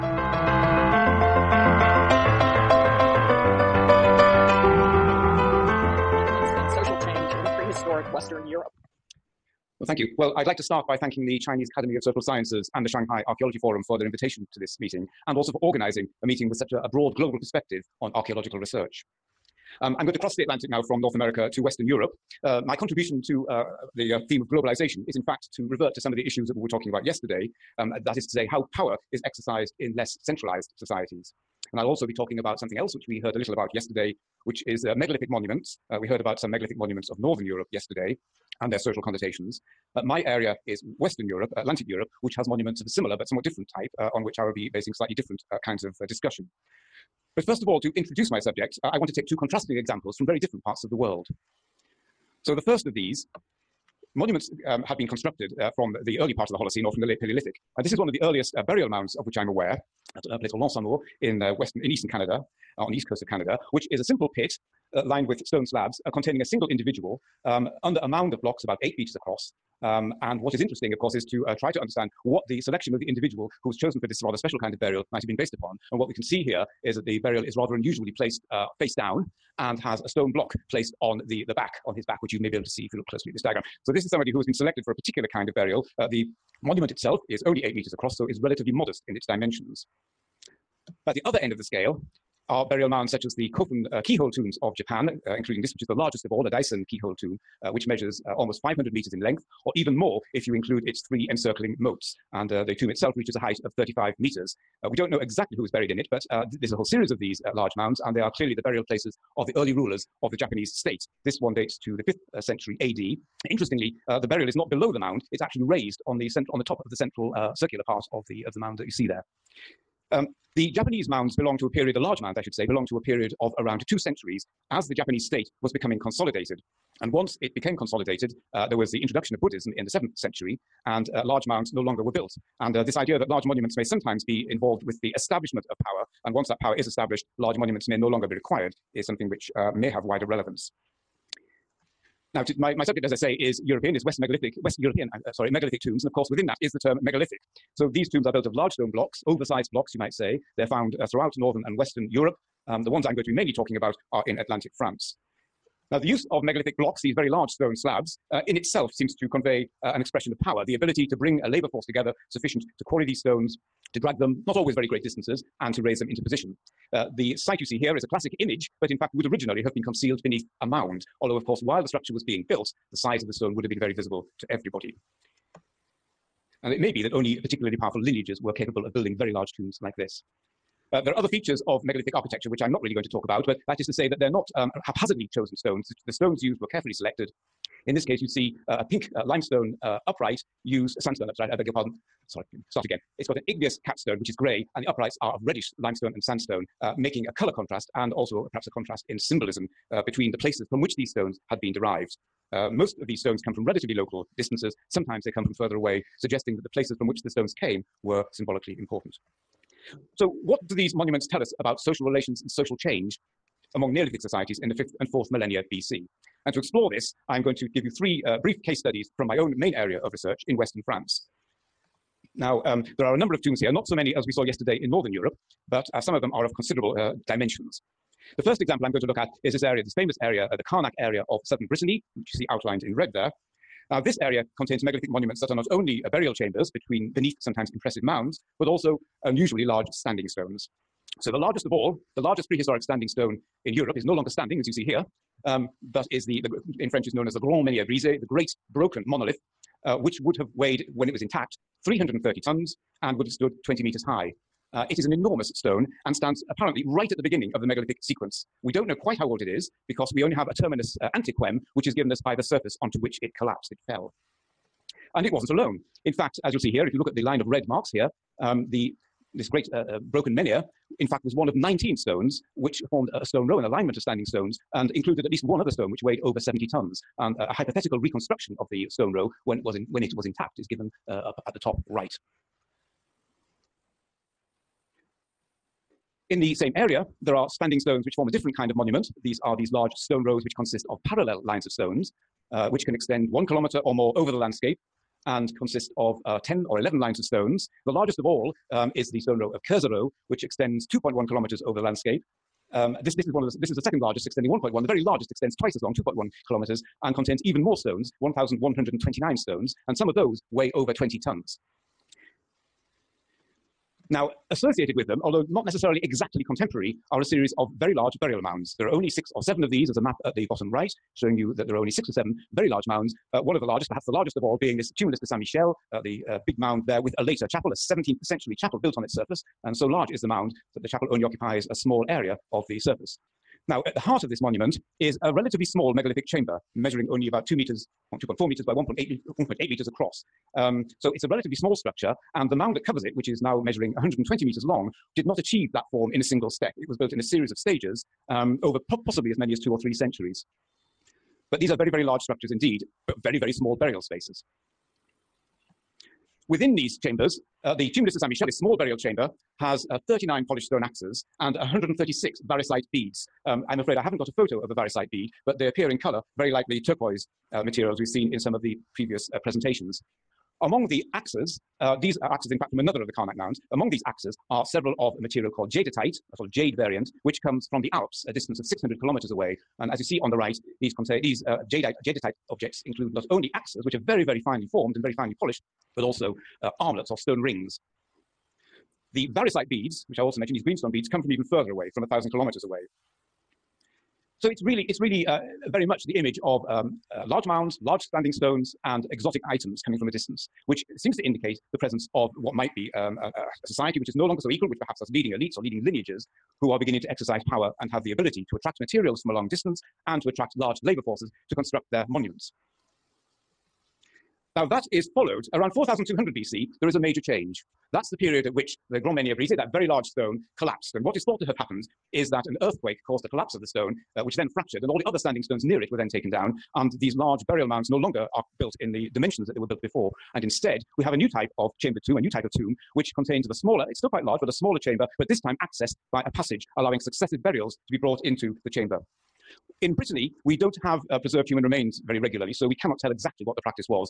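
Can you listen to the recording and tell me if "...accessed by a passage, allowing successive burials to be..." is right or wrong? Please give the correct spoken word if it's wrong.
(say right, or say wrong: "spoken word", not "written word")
right.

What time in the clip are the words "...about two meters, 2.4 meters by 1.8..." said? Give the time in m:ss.
5:37.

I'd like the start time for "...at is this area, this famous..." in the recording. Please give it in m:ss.
3:49.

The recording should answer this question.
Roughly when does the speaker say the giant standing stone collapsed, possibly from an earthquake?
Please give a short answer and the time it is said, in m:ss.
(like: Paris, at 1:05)
4200 BC, at 6:55.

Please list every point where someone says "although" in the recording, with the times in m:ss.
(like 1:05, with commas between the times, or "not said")
2:51, 5:15.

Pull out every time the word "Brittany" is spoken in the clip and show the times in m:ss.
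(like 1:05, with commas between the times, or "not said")
3:51, 7:19.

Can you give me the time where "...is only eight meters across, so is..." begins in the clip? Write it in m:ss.
1:27.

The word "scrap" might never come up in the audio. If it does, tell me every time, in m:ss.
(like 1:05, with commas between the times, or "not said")
not said.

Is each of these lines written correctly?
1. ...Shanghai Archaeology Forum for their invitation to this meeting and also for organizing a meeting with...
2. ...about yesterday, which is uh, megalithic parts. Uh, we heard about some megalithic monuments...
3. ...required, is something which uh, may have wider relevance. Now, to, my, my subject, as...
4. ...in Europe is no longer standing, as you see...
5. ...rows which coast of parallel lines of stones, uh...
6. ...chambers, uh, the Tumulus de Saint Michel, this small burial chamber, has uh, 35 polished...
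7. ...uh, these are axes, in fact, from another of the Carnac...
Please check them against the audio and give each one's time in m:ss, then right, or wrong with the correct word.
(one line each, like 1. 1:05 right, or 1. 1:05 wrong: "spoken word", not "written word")
1. 0:12 right
2. 0:33 wrong: "monuments", not "parts"
3. 2:18 right
4. 4:03 right
5. 4:50 wrong: "consist", not "coast"
6. 5:57 wrong: "39", not "35"
7. 6:11 right.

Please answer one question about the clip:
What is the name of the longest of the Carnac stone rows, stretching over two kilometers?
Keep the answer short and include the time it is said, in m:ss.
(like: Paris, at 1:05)
Kerzerho, at 4:59.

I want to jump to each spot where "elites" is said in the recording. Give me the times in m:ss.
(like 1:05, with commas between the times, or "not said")
6:45.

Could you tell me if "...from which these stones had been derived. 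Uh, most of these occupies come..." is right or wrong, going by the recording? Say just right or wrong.
wrong.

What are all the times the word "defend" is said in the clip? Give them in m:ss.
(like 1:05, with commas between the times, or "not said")
not said.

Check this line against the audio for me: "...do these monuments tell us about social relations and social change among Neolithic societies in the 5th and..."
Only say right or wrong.
right.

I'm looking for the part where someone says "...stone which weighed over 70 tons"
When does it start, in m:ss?
4:35.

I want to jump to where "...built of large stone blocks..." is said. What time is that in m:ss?
2:28.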